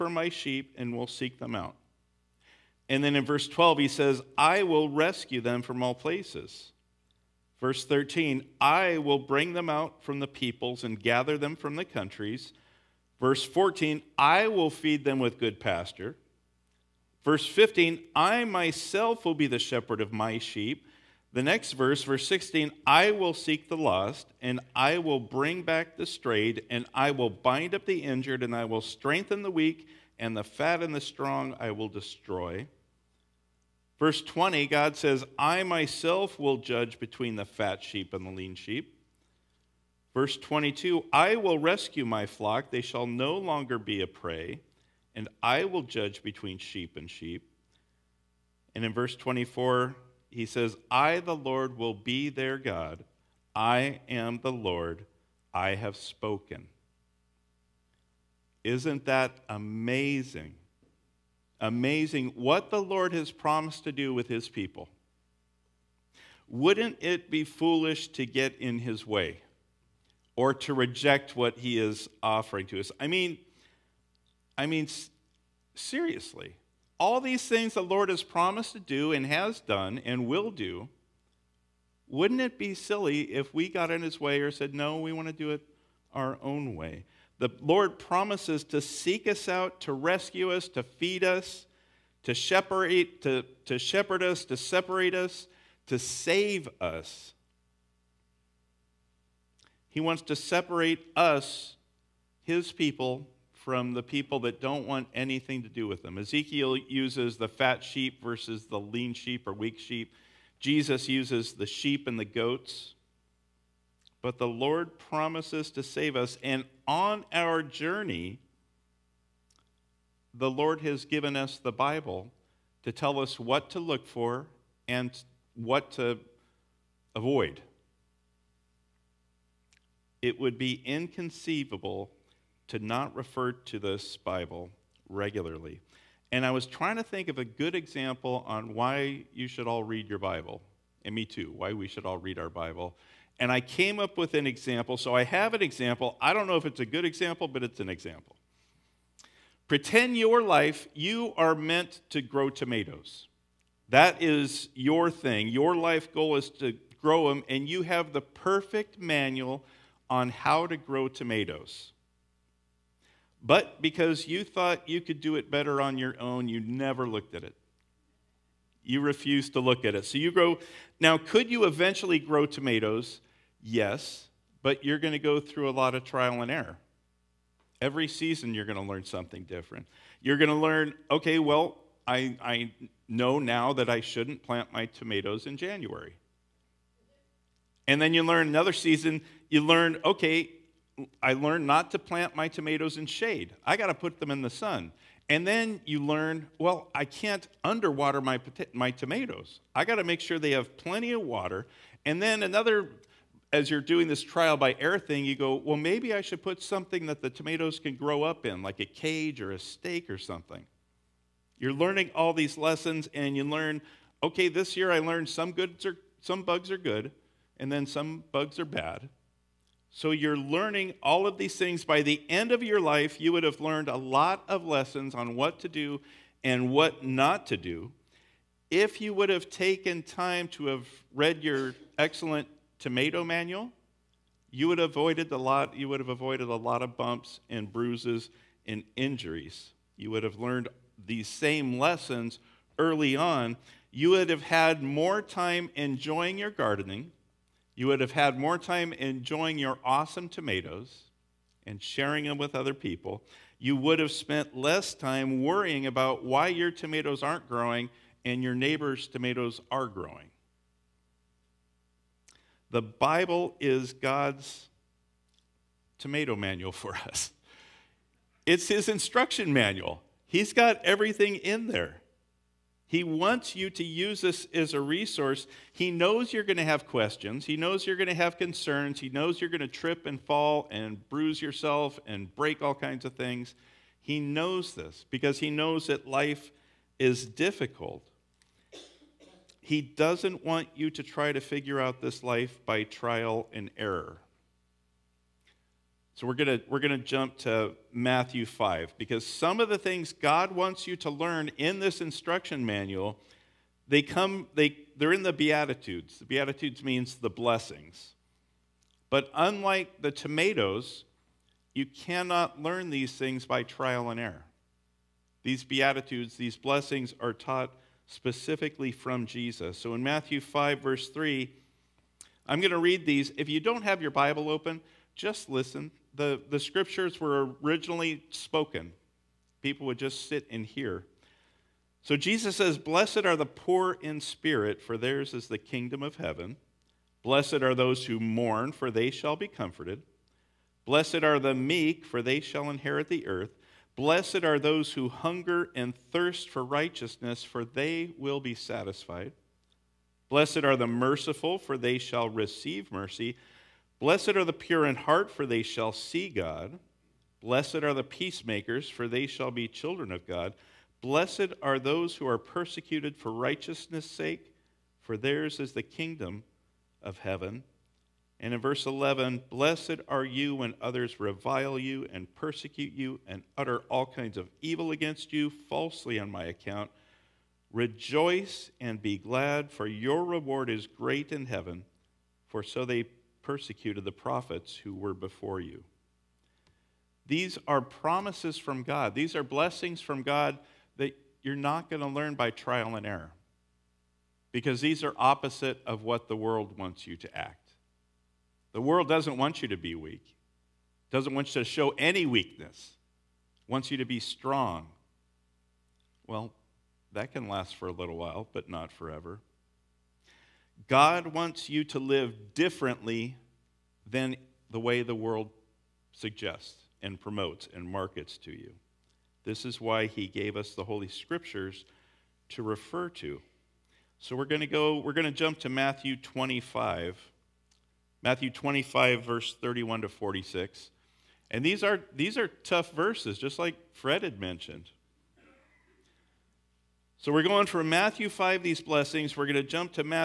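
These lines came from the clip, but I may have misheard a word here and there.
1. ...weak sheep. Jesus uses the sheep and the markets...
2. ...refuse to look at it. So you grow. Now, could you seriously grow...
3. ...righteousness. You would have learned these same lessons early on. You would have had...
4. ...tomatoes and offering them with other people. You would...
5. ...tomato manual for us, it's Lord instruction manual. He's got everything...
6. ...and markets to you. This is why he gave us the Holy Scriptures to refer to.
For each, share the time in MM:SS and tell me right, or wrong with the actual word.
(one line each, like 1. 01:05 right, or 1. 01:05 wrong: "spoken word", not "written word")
1. 01:49 wrong: "goats", not "markets"
2. 02:48 wrong: "eventually", not "seriously"
3. 03:58 wrong: "injuries", not "righteousness"
4. 04:10 wrong: "sharing", not "offering"
5. 04:25 wrong: "His", not "Lord"
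6. 06:57 right.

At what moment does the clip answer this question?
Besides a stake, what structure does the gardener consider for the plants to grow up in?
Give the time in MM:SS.
03:28.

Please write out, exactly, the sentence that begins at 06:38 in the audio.
The world doesn't want you to be weak, doesn't want you to show any weakness, wants you to be strong.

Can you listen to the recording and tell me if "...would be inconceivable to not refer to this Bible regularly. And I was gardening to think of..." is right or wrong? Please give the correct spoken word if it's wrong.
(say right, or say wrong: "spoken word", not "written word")
wrong: "trying", not "gardening".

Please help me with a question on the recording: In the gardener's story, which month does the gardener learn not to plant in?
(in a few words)
January.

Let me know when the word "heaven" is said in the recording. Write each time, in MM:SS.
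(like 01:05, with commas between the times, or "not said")
05:36, 06:07, 06:21.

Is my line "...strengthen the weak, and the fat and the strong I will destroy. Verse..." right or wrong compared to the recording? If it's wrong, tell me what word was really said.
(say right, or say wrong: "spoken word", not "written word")
right.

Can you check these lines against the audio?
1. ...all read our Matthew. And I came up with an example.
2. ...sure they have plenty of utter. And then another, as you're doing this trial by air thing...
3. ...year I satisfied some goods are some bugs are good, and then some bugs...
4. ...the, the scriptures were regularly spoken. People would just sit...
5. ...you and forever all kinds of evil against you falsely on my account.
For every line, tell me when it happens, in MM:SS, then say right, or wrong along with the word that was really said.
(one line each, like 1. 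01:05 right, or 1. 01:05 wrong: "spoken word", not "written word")
1. 02:22 wrong: "Bible", not "Matthew"
2. 03:20 wrong: "water", not "utter"
3. 03:34 wrong: "learned", not "satisfied"
4. 05:26 wrong: "originally", not "regularly"
5. 06:12 wrong: "utter", not "forever".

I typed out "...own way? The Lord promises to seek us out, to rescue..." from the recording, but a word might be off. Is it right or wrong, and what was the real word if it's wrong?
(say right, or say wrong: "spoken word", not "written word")
right.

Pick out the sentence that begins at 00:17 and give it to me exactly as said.
Verse 15, I myself will be the shepherd of my sheep.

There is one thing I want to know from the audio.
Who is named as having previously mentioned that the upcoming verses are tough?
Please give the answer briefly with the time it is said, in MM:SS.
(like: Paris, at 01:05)
Fred, at 07:13.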